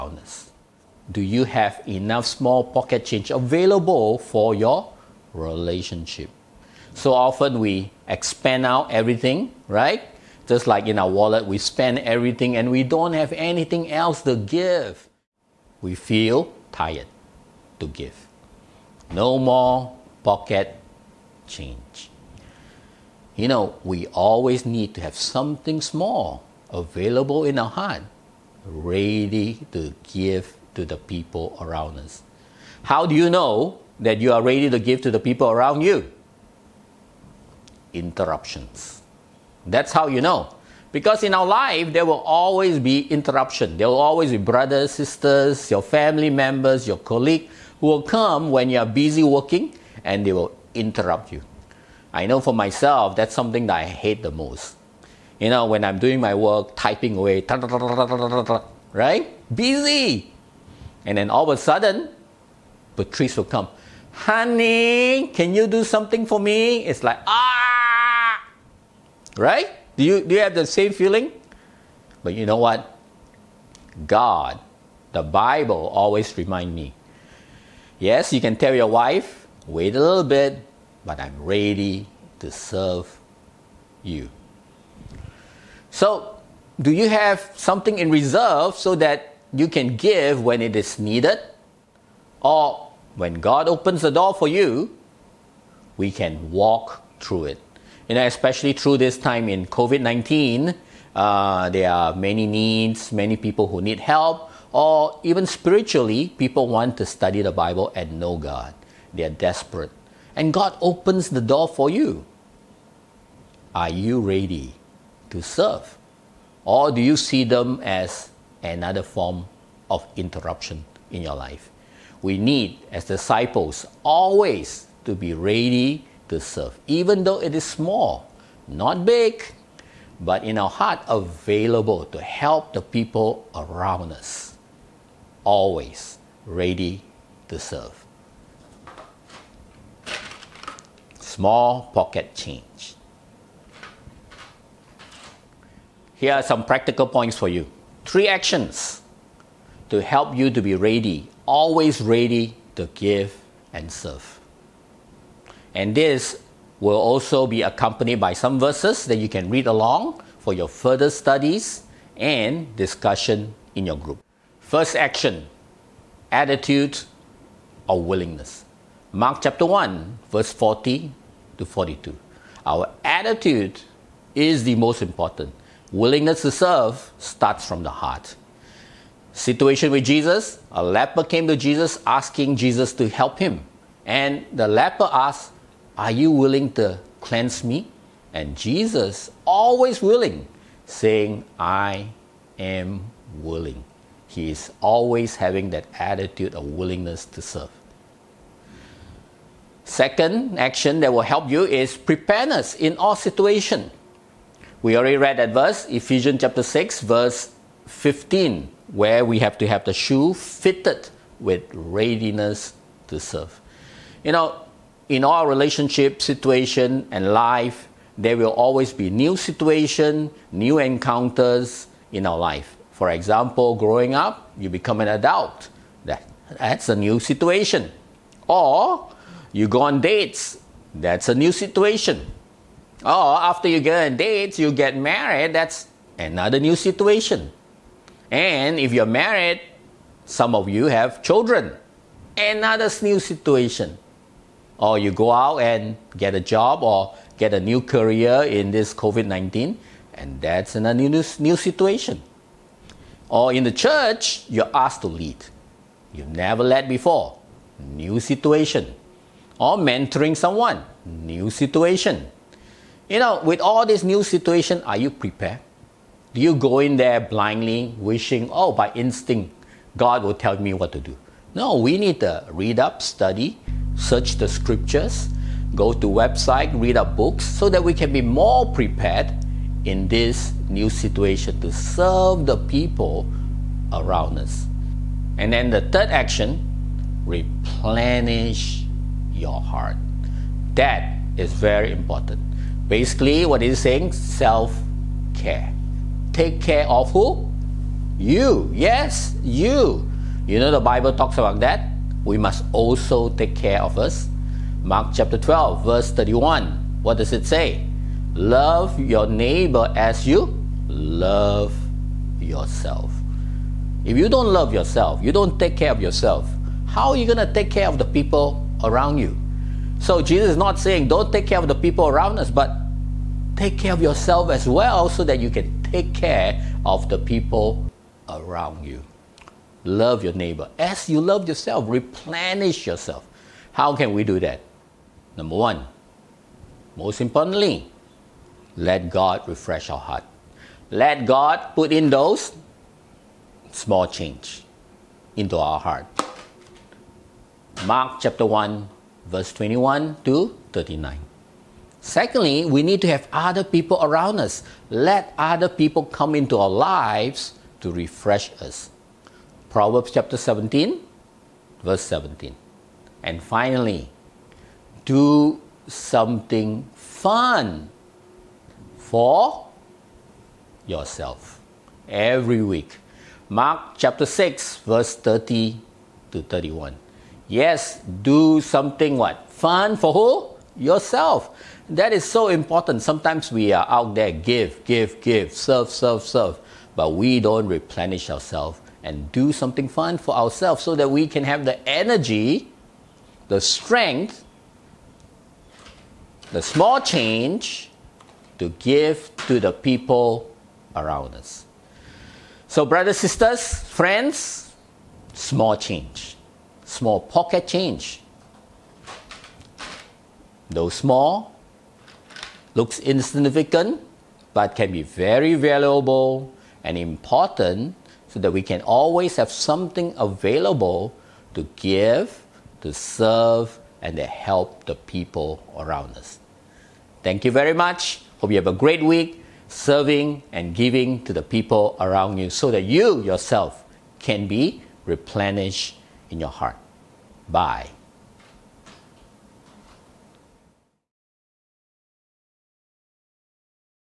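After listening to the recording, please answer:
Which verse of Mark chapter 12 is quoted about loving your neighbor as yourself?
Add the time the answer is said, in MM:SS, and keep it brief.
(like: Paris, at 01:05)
Verse 31, at 05:05.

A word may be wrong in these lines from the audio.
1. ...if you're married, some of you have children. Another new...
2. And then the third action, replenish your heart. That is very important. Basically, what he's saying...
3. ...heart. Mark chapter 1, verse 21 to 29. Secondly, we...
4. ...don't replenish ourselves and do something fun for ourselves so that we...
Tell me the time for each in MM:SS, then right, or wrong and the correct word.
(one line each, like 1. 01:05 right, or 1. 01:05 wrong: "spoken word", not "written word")
1. 03:58 right
2. 04:45 right
3. 05:45 wrong: "39", not "29"
4. 06:27 right.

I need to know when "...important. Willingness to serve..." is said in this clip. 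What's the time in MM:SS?
02:55.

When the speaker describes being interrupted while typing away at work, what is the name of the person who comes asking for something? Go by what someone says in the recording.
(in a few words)
Patrice.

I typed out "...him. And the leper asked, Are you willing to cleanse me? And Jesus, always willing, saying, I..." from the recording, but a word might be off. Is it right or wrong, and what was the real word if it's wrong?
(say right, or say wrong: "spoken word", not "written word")
right.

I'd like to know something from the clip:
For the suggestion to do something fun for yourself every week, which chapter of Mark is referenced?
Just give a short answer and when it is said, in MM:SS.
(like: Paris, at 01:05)
Chapter 6, at 06:13.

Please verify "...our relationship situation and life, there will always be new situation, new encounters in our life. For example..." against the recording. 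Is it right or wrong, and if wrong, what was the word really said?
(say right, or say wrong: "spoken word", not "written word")
right.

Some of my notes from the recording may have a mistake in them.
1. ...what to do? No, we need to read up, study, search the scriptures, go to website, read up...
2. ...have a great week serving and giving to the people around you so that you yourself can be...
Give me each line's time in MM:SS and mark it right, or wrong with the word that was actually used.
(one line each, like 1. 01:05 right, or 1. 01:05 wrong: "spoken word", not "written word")
1. 04:30 right
2. 07:08 right.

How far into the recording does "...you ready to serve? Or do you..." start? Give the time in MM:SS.
01:53.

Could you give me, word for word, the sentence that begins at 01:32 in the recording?
Or when God opens the door for you, we can walk through it.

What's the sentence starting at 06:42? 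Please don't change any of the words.
So, brothers, sisters, friends, small change, small pocket change.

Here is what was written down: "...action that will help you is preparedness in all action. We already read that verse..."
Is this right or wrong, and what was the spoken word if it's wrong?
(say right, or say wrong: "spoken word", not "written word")
wrong: "situation", not "action".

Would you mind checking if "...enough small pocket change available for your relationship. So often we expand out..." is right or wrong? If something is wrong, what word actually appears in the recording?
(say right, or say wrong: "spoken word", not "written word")
right.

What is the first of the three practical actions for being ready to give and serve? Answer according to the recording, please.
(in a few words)
Attitude or willingness.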